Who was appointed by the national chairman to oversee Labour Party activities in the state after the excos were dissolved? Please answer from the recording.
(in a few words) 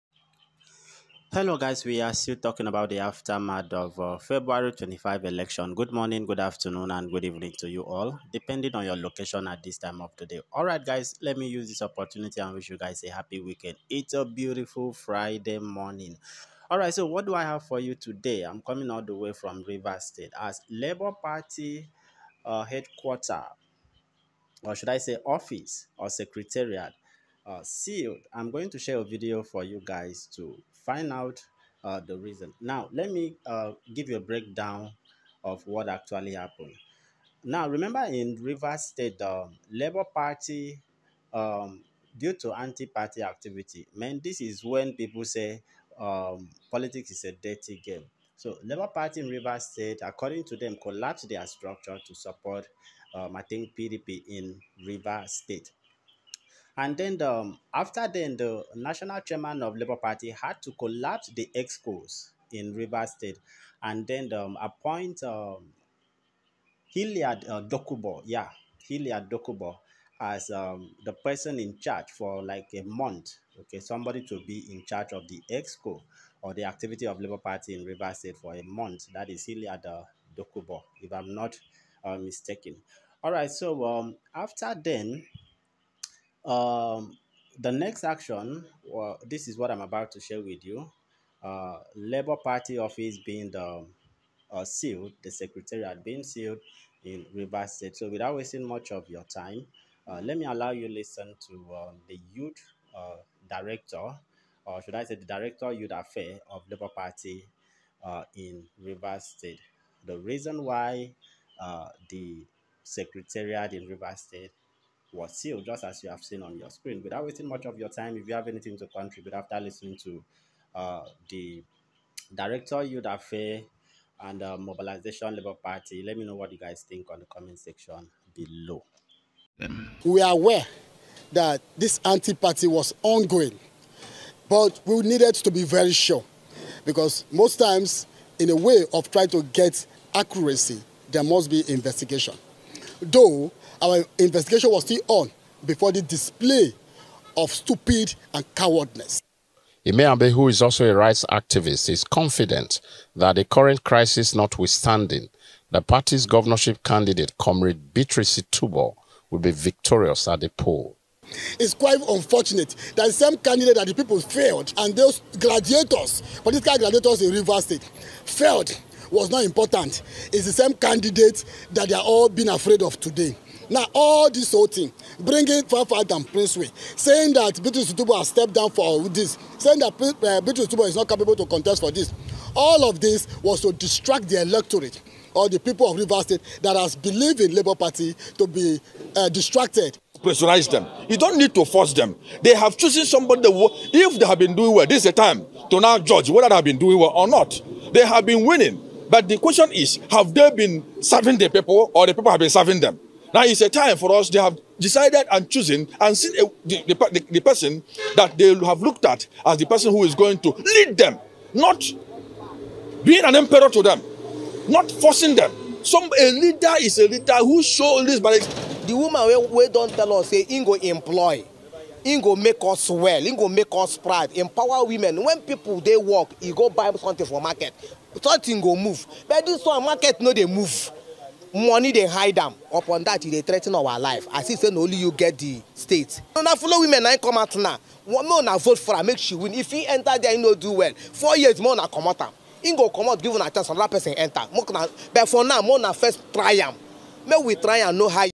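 Hilliard Dokubo.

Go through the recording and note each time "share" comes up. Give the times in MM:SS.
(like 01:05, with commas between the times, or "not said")
00:28, 01:30.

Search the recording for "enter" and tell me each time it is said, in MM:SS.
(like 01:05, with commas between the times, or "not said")
03:59, 04:04.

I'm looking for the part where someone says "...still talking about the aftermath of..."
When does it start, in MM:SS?
00:02.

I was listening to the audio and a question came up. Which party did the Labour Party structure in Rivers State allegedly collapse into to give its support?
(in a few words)
PDP.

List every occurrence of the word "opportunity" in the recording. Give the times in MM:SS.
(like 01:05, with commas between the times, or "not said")
00:11.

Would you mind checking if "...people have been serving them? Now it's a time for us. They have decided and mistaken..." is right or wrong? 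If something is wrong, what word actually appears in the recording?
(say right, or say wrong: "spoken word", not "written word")
wrong: "chosen", not "mistaken".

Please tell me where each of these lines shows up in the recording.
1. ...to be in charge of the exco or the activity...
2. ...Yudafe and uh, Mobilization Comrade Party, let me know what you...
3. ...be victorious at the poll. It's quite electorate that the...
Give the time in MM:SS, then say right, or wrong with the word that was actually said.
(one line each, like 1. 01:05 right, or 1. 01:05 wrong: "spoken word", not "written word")
1. 01:14 right
2. 02:02 wrong: "Labour", not "Comrade"
3. 02:39 wrong: "unfortunate", not "electorate".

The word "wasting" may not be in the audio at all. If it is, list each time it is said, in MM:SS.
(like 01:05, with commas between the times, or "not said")
01:38, 01:57.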